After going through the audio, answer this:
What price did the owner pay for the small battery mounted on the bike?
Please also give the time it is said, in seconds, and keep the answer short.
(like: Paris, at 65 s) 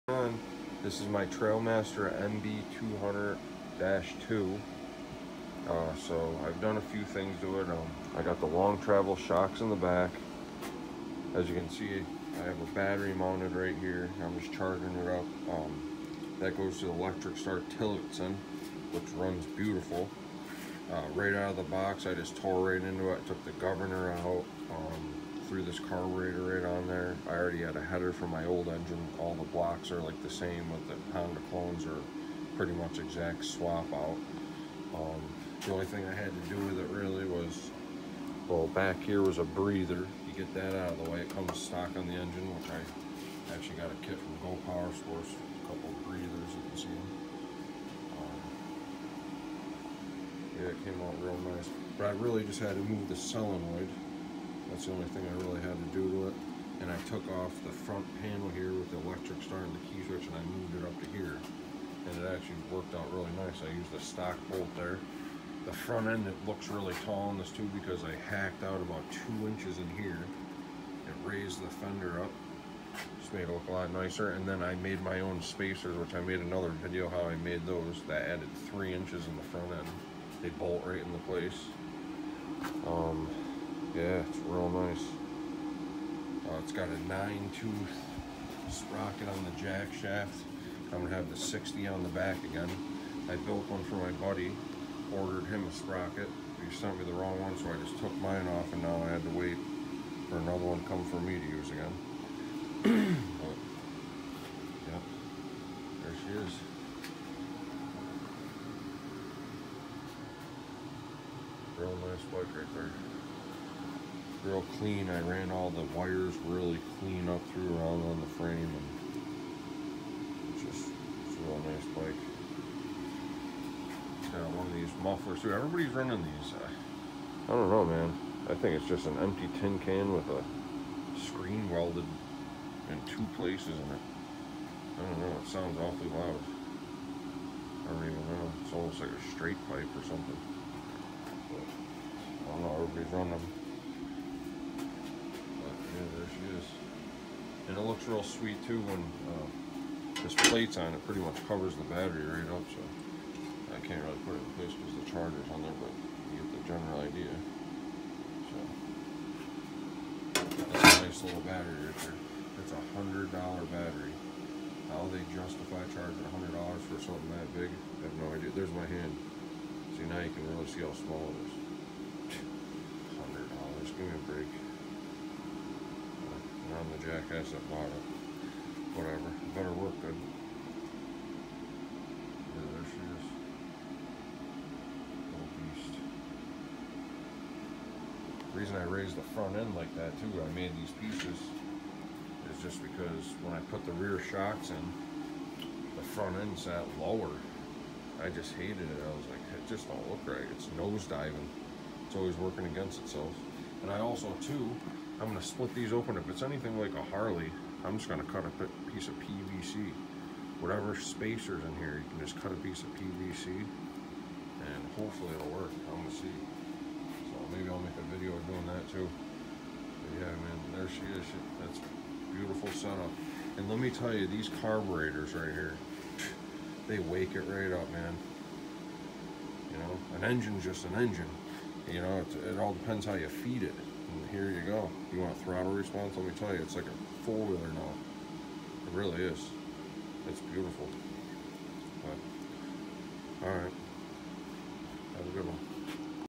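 $100, at 162 s.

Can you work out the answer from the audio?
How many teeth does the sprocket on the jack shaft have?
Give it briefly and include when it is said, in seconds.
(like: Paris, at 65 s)
9, at 87 s.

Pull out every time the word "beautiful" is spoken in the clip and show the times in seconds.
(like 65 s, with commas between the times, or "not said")
19 s, 222 s, 240 s.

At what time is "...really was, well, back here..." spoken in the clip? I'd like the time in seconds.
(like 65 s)
36 s.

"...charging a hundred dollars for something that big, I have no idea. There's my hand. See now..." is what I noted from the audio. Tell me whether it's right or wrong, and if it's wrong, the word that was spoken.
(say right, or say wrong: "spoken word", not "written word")
right.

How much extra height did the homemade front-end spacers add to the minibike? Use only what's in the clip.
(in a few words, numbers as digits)
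3 inches.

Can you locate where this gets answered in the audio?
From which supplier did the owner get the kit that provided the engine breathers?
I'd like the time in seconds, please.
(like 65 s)
44 s.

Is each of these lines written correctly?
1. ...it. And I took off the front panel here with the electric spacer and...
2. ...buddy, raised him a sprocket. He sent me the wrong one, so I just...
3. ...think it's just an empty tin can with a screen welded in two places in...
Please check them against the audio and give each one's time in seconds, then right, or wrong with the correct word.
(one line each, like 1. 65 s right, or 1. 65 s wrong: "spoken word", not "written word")
1. 56 s wrong: "starter", not "spacer"
2. 94 s wrong: "ordered", not "raised"
3. 128 s right.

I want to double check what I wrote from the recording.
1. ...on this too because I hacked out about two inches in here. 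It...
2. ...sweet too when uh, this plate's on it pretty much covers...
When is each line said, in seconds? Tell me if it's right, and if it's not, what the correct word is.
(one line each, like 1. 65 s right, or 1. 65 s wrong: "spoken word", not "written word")
1. 67 s right
2. 148 s right.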